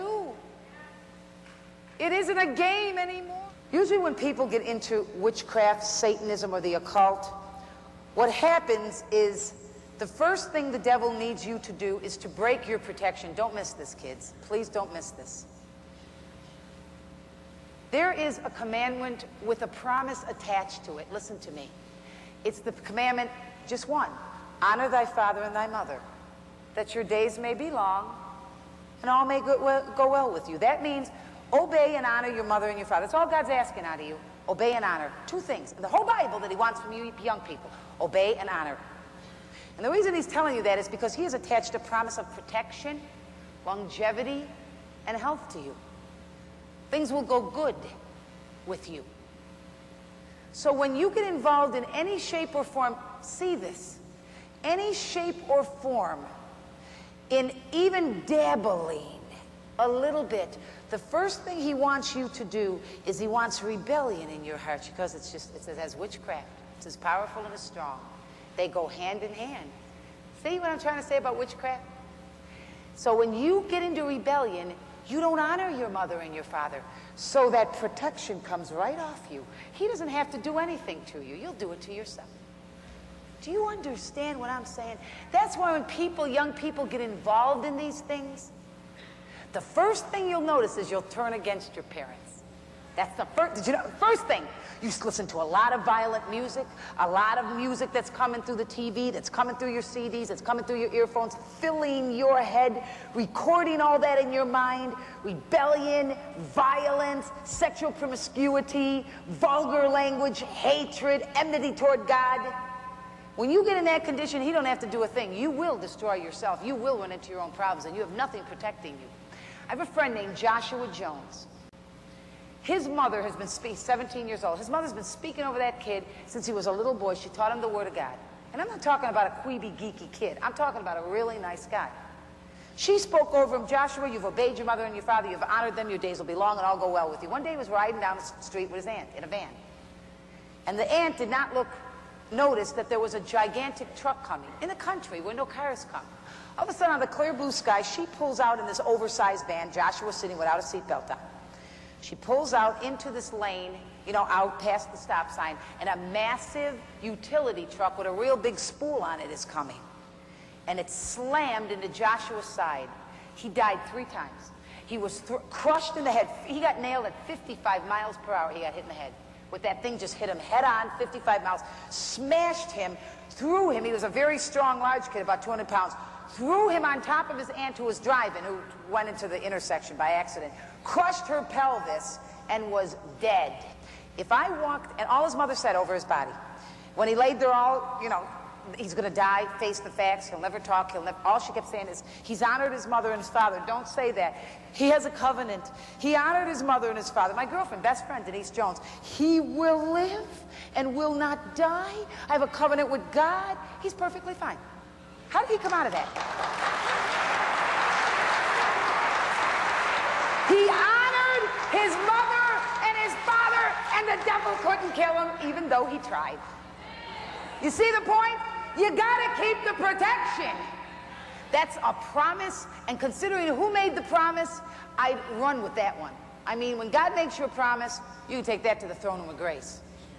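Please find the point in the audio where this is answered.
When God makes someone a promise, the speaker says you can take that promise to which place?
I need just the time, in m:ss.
3:48.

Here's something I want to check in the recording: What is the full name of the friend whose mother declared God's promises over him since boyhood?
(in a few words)
Joshua Jones.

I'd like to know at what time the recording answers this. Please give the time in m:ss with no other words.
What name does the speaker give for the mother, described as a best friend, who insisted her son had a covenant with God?
3:18.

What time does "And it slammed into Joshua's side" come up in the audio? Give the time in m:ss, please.
2:40.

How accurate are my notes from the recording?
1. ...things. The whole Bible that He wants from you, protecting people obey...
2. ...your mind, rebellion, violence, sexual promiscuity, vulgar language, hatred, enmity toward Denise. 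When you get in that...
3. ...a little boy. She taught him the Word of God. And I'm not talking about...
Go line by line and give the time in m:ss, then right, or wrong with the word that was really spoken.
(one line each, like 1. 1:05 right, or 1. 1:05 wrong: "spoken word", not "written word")
1. 0:35 wrong: "young", not "protecting"
2. 1:44 wrong: "God", not "Denise"
3. 2:06 right.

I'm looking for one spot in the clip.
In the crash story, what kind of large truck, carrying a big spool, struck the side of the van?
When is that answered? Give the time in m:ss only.
2:37.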